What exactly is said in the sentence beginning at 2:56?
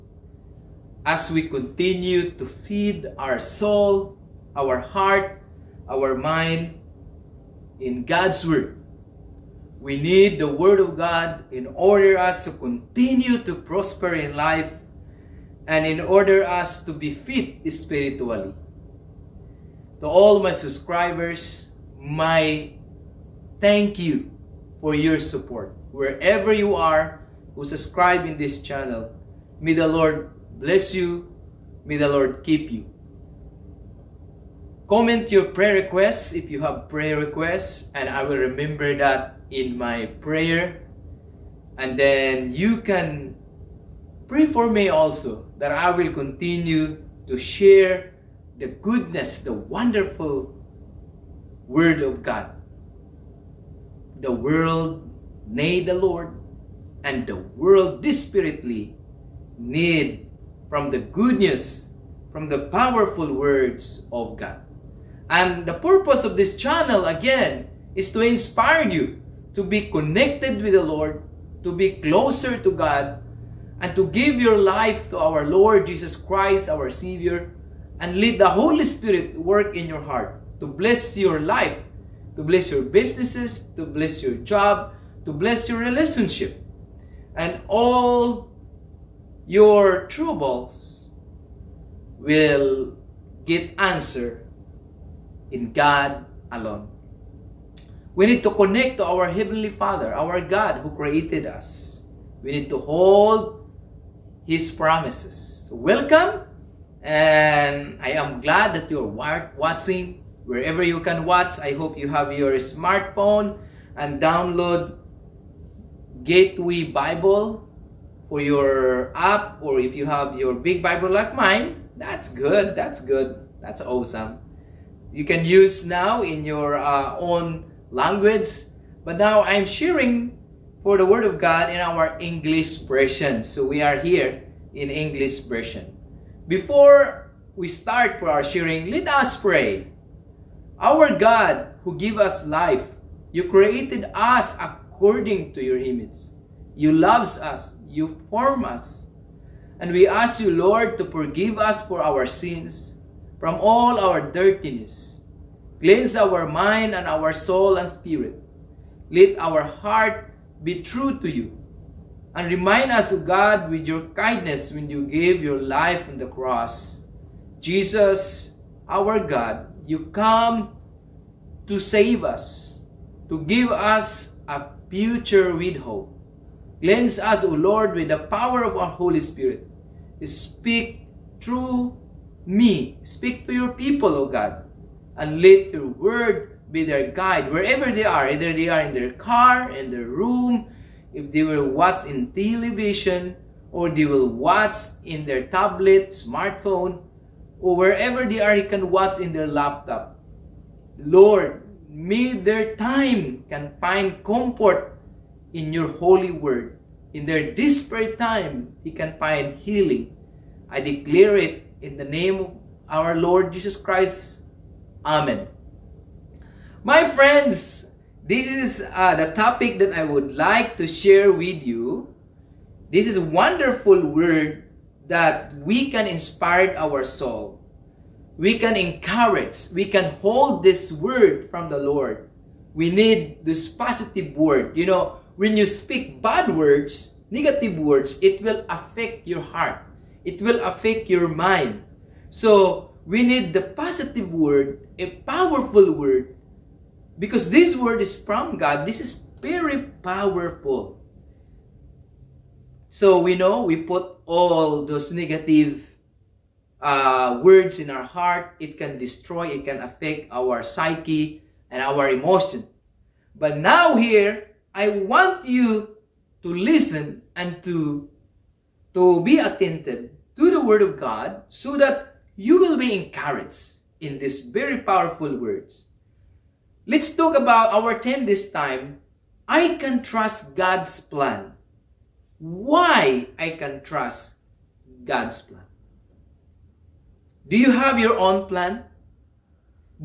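Cleanse us, O Lord, with the power of our Holy Spirit.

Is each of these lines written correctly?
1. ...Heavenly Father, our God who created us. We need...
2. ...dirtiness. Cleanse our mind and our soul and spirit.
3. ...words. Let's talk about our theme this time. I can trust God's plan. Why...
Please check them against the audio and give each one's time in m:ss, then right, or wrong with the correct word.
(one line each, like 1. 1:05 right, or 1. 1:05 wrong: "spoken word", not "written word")
1. 1:39 right
2. 2:34 right
3. 4:35 right.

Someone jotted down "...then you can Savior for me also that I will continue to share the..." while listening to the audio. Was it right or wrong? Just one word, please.
wrong.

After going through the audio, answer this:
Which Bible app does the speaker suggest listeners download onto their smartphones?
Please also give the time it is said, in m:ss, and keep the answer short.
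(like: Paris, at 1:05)
Gateway Bible, at 1:56.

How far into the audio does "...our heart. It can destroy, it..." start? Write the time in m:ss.
4:17.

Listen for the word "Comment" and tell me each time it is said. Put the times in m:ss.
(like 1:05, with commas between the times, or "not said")
0:34.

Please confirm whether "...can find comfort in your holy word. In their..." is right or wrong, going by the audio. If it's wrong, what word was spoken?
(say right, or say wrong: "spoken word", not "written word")
right.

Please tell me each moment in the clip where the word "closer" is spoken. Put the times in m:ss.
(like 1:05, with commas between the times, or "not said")
1:12.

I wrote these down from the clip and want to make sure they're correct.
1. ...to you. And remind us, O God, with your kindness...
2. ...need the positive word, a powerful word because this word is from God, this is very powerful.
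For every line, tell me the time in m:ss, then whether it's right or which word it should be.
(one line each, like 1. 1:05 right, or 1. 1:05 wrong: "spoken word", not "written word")
1. 2:41 right
2. 4:03 right.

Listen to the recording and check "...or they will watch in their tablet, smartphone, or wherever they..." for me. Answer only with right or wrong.
right.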